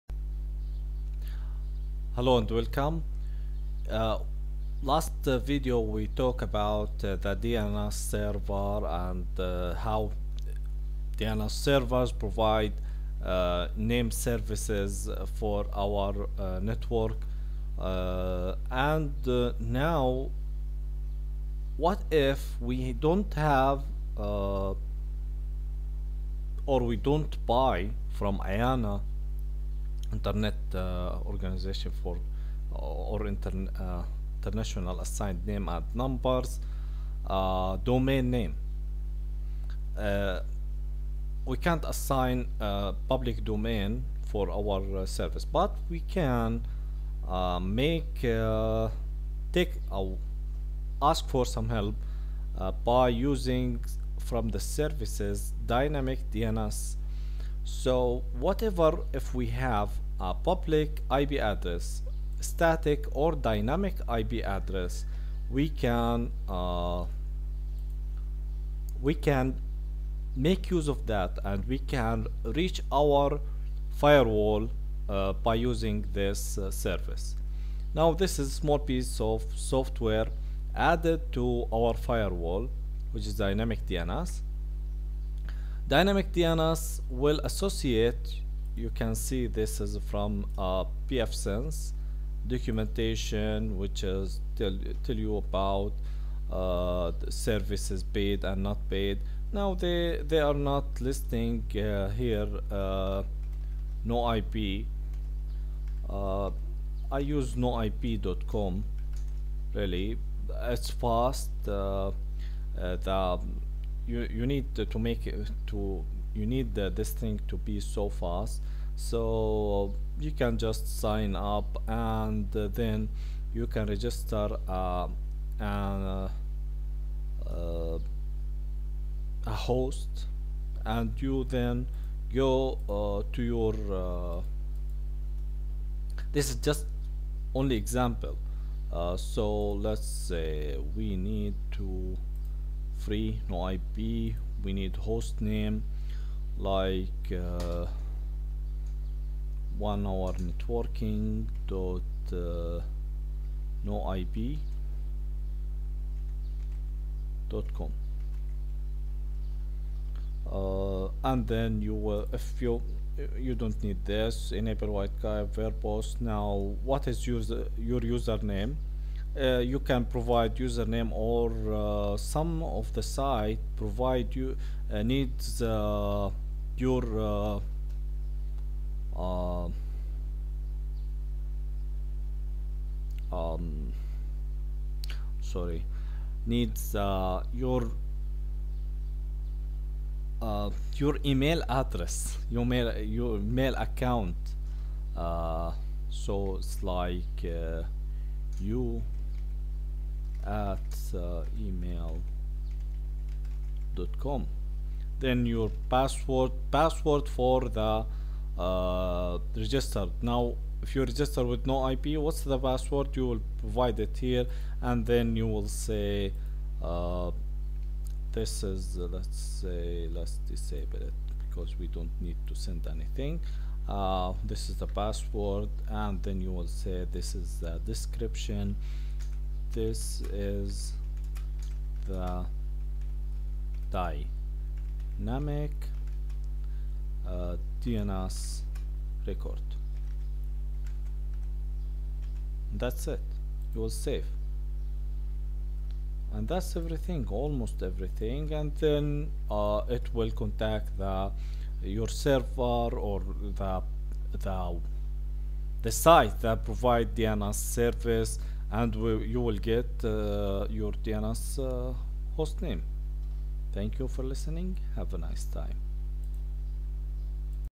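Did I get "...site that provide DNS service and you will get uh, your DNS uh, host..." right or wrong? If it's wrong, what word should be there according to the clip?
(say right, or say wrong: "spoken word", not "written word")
right.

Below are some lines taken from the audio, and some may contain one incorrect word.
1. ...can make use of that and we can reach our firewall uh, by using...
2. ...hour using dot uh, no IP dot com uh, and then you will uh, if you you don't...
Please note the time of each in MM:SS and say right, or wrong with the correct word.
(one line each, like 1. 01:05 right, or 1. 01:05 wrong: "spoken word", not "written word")
1. 01:09 right
2. 02:30 wrong: "networking", not "using".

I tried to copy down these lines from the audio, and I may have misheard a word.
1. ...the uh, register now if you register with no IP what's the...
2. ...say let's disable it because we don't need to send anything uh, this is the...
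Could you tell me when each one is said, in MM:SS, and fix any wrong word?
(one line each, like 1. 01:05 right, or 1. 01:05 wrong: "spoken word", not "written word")
1. 03:27 right
2. 03:39 right.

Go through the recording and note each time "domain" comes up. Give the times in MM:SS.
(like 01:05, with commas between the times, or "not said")
00:37, 00:43.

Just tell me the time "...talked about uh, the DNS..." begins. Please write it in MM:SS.
00:06.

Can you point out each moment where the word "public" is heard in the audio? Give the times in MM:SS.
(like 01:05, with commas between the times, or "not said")
00:43, 01:00.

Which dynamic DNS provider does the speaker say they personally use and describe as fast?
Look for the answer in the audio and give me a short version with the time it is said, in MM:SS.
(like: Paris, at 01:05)
noip.com, at 01:47.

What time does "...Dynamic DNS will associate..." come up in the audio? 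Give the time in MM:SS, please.
01:25.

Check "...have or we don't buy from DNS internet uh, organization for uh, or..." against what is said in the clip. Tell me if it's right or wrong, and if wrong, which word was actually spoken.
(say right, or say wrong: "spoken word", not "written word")
wrong: "IANA", not "DNS".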